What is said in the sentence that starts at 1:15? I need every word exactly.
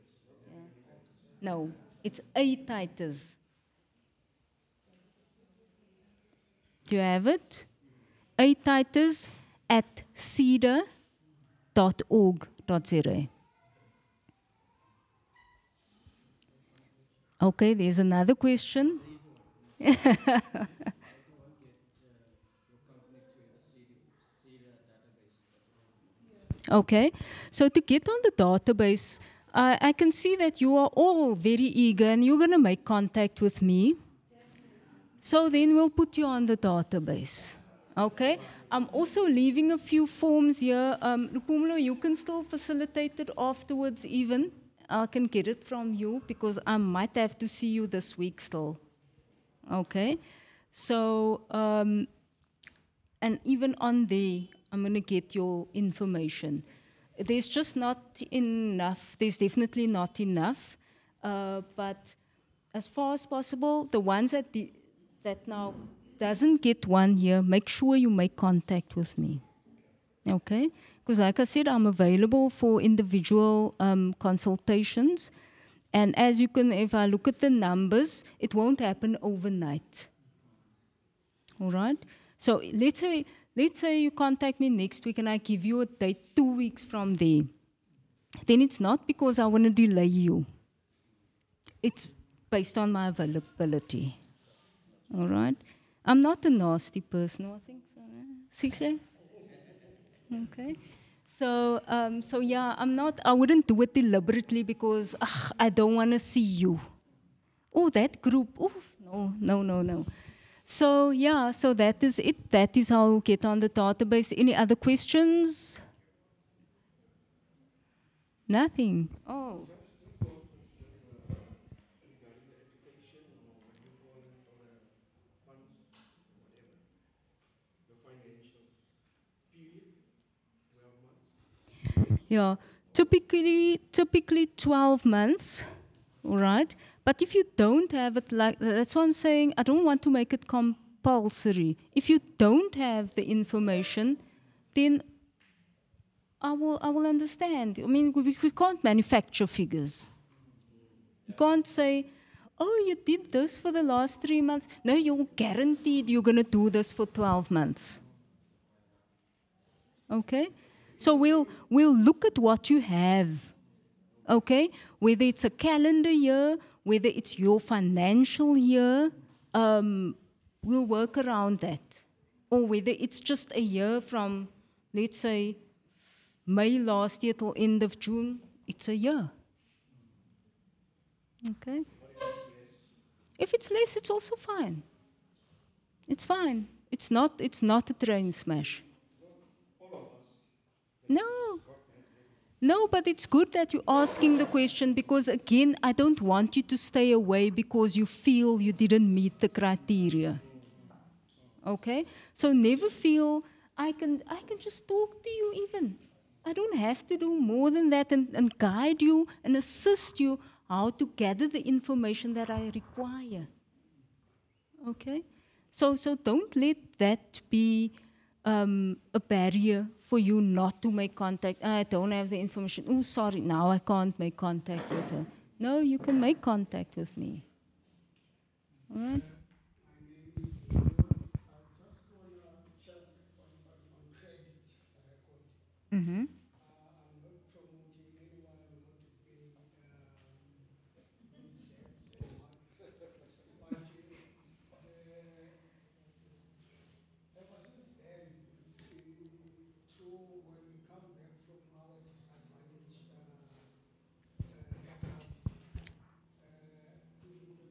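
And as you can, if I look at the numbers, it won't happen overnight.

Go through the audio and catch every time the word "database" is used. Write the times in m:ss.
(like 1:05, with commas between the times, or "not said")
0:28, 0:36, 1:53.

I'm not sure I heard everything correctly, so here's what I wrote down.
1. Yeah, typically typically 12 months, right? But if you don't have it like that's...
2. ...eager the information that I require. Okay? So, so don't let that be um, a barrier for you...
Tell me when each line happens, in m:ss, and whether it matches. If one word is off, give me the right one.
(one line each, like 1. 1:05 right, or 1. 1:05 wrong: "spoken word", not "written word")
1. 2:12 right
2. 3:31 wrong: "gather", not "eager".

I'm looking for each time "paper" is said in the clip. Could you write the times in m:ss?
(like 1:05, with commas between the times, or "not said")
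not said.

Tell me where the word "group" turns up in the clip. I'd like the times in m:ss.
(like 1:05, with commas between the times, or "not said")
1:48.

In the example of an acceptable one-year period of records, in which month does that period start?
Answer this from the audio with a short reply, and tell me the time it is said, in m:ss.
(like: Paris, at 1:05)
May, at 2:56.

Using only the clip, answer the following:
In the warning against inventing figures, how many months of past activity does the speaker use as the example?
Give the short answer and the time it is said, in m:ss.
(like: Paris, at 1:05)
three months, at 2:34.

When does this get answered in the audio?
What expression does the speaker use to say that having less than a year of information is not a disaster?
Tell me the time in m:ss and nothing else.
3:07.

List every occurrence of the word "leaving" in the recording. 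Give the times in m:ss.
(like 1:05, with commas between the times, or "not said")
0:39.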